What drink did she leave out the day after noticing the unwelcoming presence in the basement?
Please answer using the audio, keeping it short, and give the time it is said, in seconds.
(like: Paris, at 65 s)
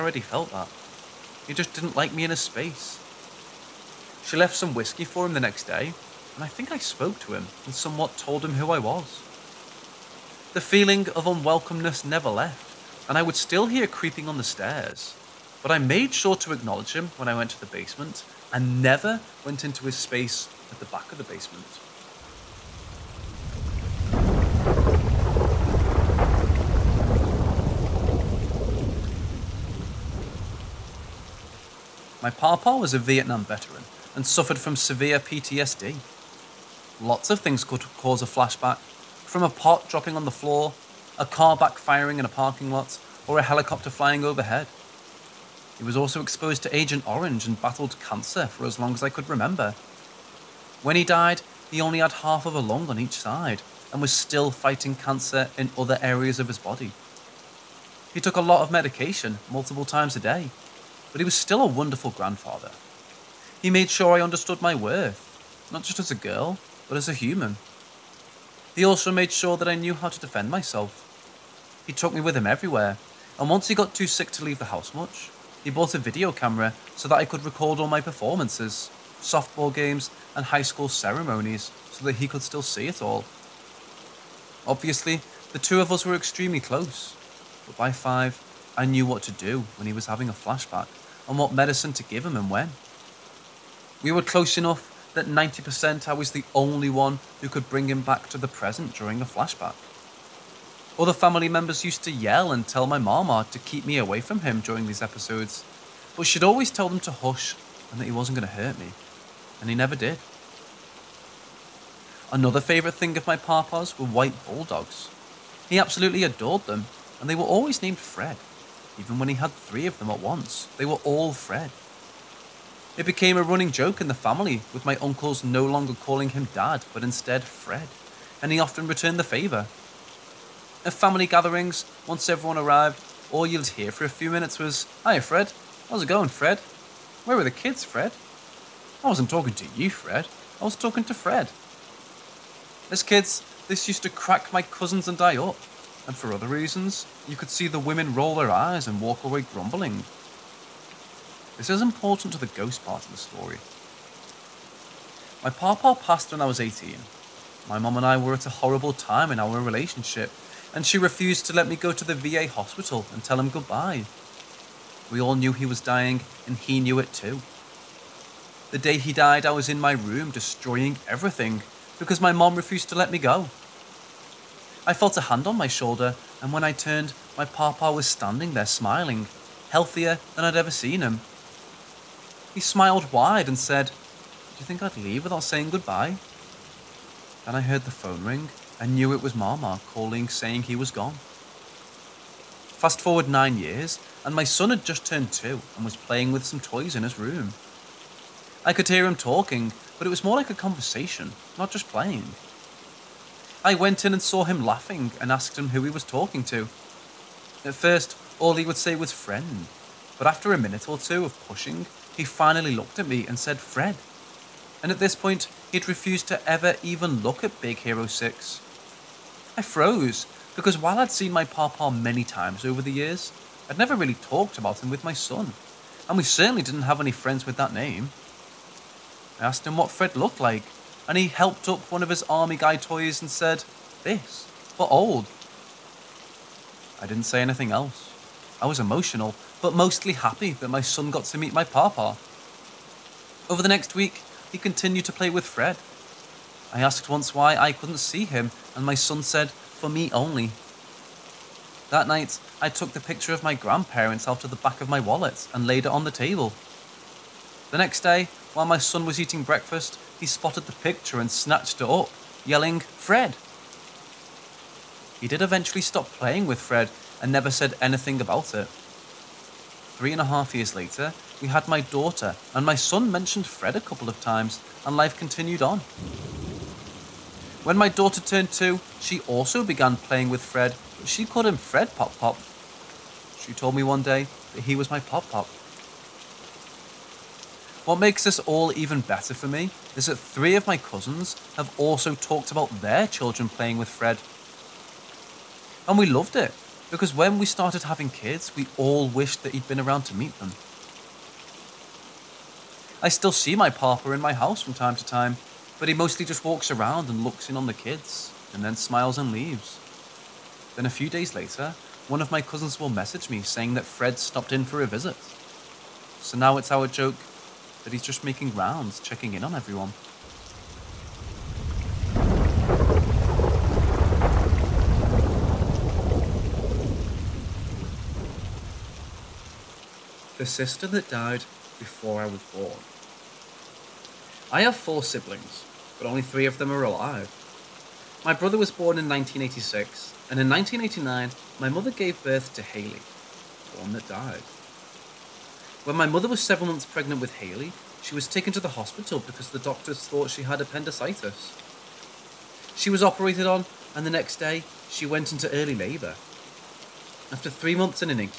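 whiskey, at 4 s.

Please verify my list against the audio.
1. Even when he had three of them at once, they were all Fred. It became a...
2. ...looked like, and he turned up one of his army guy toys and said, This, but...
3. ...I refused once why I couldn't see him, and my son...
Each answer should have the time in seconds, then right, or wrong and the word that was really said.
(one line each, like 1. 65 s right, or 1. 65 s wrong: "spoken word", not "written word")
1. 118 s right
2. 230 s wrong: "helped", not "turned"
3. 246 s wrong: "asked", not "refused".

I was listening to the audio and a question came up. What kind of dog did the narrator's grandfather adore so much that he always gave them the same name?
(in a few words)
white bulldogs.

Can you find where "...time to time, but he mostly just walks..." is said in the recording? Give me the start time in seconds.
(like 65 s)
304 s.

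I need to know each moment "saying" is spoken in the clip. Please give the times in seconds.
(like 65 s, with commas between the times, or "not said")
185 s, 190 s, 313 s.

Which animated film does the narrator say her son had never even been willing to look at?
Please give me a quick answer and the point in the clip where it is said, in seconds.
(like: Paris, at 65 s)
Big Hero 6, at 217 s.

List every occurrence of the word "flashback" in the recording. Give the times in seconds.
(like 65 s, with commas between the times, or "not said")
38 s, 90 s, 99 s.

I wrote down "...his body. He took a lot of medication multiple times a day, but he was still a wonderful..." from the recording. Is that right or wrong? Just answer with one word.
right.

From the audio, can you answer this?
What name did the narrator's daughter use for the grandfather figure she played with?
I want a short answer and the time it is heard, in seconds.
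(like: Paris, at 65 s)
Fred Pop Pop, at 281 s.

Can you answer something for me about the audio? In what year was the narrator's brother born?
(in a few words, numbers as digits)
1986.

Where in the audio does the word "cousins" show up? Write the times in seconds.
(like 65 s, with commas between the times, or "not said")
144 s, 290 s, 312 s.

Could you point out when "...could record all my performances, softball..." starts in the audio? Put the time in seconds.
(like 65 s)
77 s.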